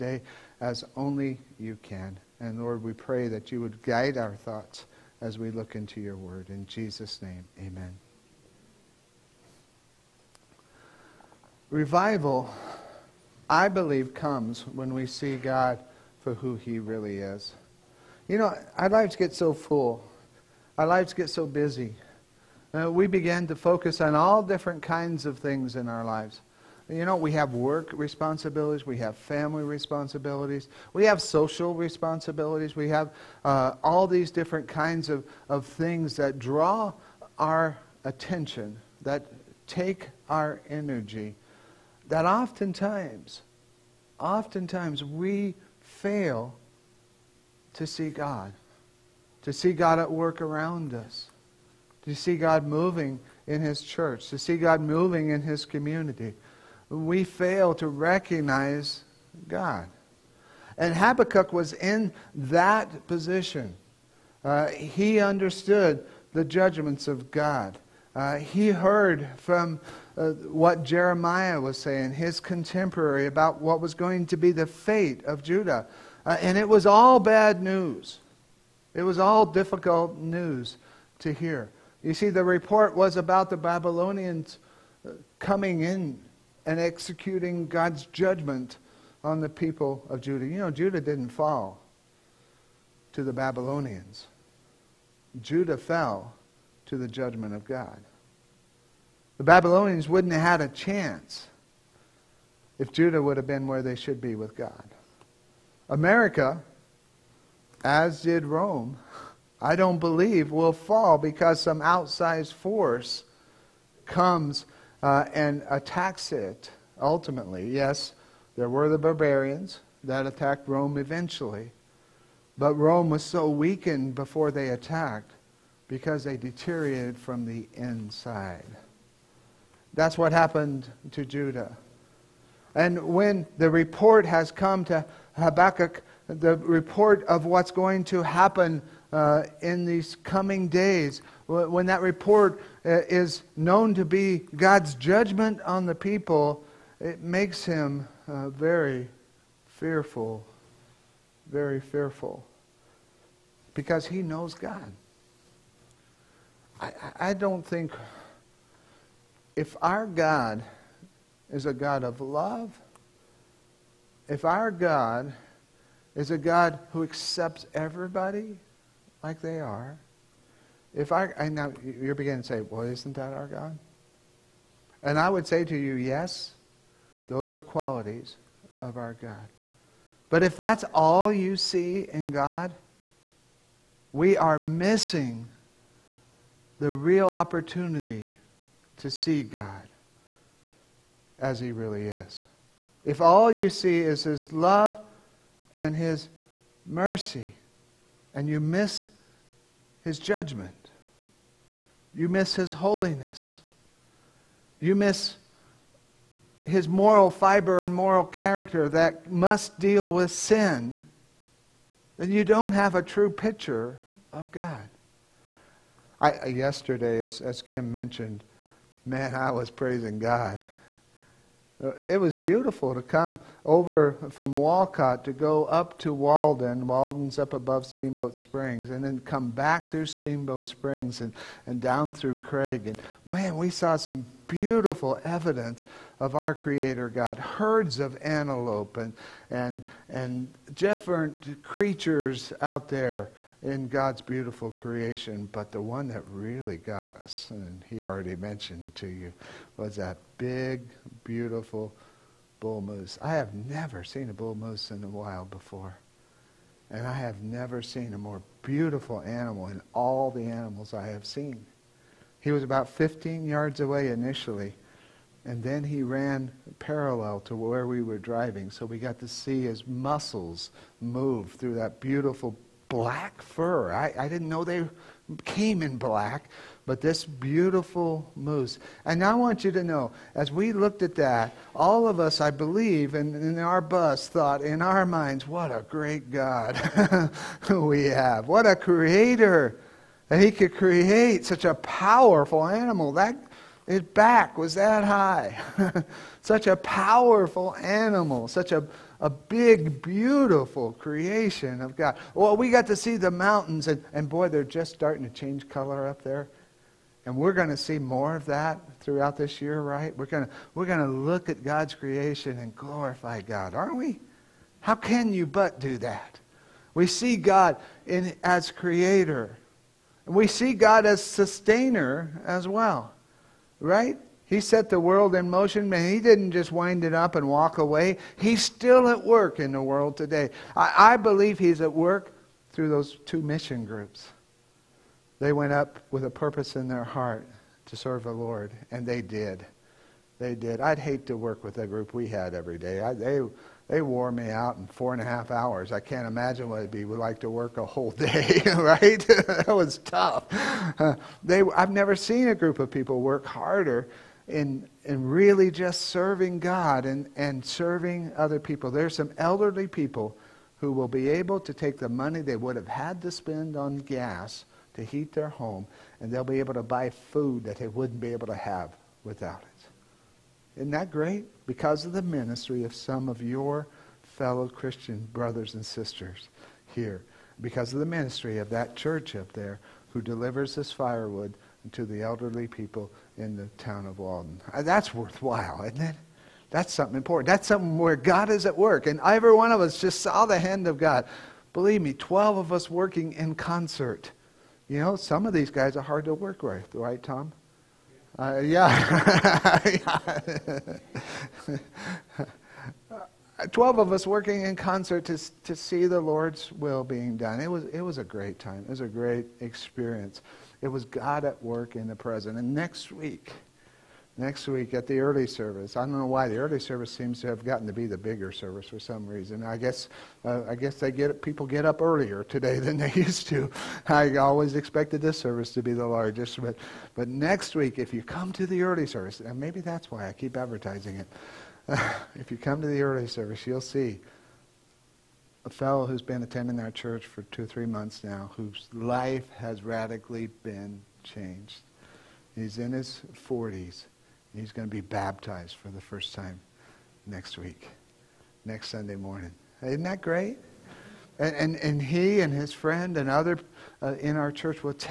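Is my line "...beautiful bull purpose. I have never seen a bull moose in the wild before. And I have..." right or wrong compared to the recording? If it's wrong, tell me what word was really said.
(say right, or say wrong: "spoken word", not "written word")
wrong: "moose", not "purpose".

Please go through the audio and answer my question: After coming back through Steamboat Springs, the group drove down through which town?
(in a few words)
Craig.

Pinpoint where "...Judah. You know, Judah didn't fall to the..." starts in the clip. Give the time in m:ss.
1:30.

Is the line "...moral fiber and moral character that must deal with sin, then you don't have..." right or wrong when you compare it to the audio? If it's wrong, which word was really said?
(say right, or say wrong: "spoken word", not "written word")
right.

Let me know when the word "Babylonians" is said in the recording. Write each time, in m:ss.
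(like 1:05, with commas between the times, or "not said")
1:23, 1:33, 1:39.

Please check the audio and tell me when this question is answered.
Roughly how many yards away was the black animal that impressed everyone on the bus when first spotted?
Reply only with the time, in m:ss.
4:22.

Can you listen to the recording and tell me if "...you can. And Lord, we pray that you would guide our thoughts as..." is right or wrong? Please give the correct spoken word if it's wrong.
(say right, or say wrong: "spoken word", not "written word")
right.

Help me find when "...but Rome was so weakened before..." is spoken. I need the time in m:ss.
2:02.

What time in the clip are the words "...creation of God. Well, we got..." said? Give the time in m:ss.
5:00.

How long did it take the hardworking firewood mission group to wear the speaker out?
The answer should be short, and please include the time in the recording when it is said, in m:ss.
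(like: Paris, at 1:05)
Four and a half hours, at 5:44.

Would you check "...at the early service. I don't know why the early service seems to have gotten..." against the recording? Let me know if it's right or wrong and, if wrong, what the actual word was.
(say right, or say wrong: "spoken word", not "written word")
right.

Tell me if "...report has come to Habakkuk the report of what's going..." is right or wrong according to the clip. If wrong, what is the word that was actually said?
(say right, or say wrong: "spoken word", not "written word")
right.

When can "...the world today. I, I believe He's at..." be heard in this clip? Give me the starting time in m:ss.
5:29.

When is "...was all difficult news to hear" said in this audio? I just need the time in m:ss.
1:19.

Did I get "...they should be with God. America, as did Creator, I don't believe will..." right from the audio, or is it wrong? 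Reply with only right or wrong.
wrong.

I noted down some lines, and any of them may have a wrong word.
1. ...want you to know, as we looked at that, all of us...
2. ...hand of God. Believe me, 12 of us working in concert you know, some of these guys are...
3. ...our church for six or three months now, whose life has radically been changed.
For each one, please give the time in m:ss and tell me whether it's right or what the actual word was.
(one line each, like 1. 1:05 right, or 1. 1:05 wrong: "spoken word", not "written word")
1. 4:39 right
2. 6:30 right
3. 7:16 wrong: "two", not "six".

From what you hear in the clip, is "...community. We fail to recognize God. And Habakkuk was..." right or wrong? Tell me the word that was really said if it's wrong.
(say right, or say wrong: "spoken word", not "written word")
right.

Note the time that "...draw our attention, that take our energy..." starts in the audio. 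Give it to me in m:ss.
0:36.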